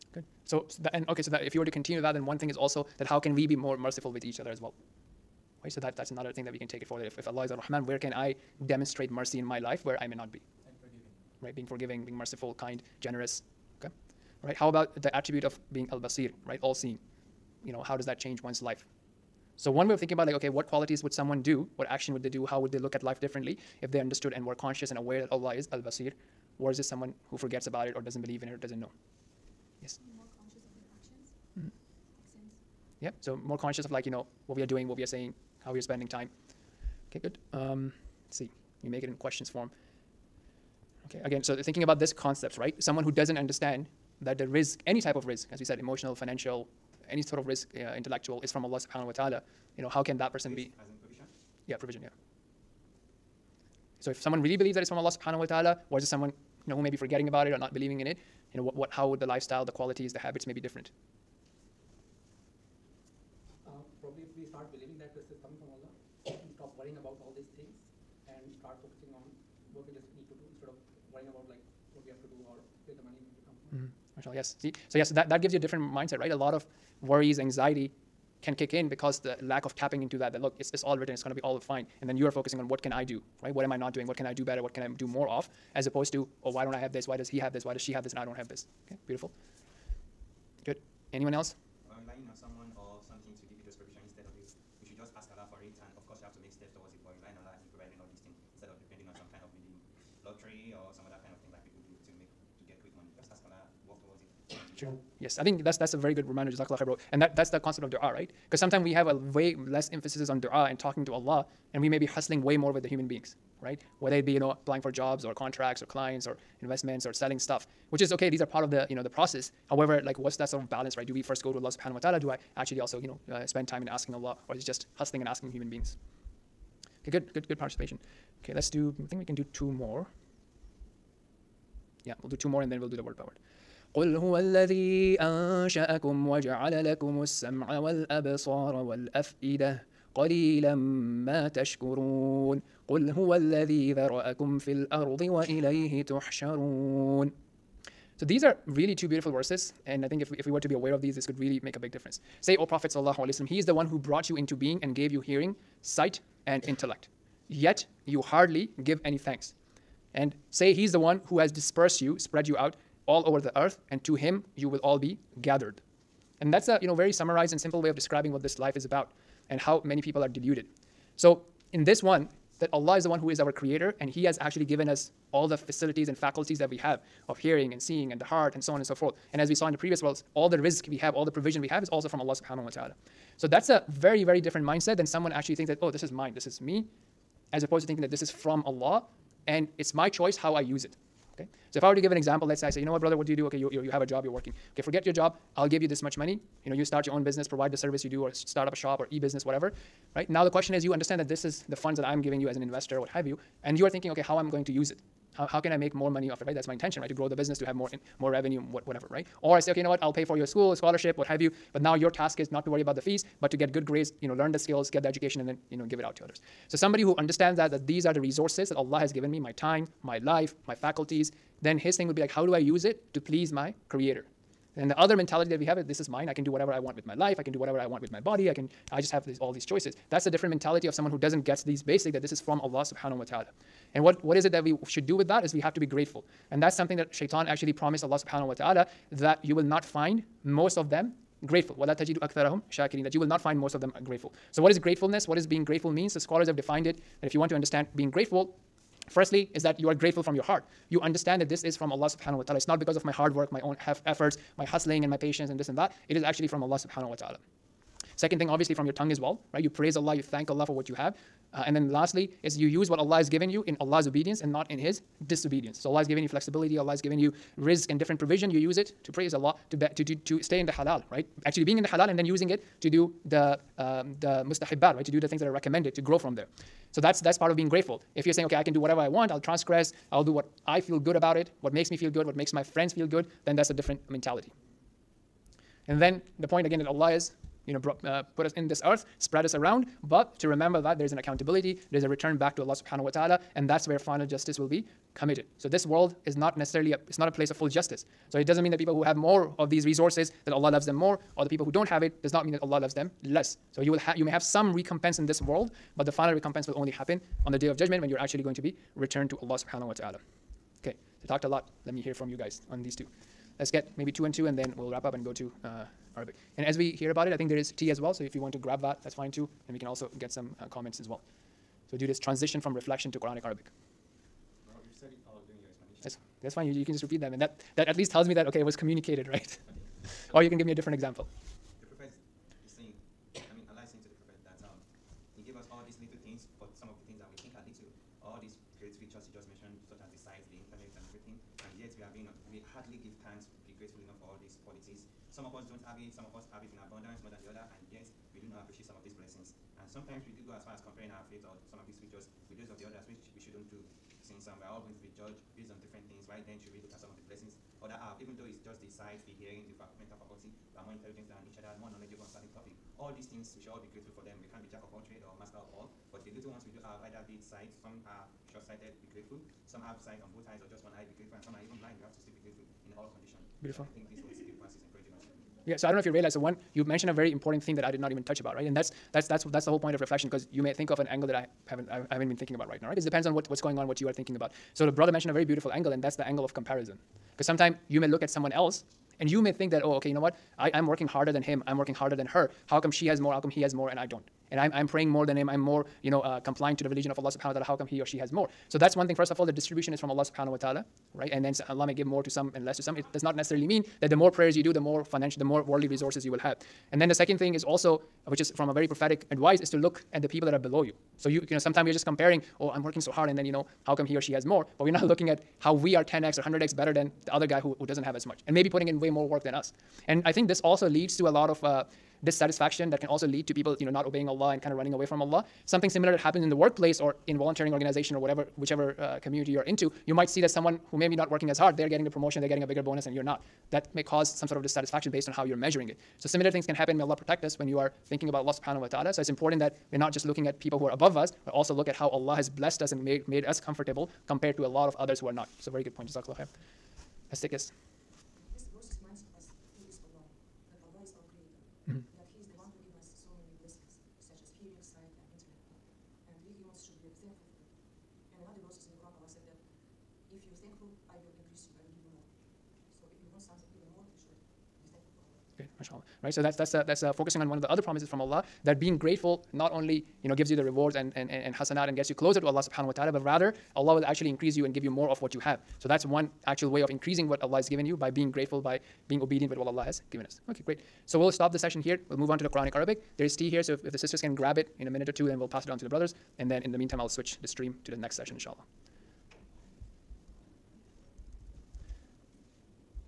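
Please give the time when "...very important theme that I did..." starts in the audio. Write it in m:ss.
6:17.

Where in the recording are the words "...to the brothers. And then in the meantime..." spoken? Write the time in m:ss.
8:05.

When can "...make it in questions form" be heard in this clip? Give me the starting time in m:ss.
0:38.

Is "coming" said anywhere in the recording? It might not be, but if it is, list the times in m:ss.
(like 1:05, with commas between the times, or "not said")
1:05.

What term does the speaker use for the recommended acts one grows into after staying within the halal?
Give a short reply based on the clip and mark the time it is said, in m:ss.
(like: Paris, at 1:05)
mustahibbat, at 4:34.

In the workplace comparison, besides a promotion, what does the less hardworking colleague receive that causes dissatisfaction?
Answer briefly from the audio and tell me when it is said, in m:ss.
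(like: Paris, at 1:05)
a bigger bonus, at 7:12.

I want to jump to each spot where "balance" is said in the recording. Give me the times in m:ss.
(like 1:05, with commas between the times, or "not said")
2:00.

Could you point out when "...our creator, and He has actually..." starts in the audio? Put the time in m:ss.
2:53.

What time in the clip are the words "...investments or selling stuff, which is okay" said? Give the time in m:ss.
1:56.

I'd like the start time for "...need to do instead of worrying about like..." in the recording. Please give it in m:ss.
1:10.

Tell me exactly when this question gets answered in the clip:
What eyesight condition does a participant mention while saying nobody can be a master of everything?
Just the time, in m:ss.
6:08.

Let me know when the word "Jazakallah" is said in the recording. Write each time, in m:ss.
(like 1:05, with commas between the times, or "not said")
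1:46, 7:26.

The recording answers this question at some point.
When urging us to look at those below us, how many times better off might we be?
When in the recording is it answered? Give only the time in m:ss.
6:56.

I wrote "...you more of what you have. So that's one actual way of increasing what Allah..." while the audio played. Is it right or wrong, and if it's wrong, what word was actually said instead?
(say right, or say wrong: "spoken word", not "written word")
right.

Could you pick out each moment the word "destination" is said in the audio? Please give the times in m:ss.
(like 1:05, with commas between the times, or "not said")
not said.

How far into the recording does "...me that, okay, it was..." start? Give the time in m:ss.
5:28.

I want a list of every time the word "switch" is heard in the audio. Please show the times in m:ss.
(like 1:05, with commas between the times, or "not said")
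8:07.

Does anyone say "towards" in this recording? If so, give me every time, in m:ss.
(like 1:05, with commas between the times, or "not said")
1:36, 1:44.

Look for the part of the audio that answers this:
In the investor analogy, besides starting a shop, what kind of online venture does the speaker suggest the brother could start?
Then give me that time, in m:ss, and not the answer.
3:19.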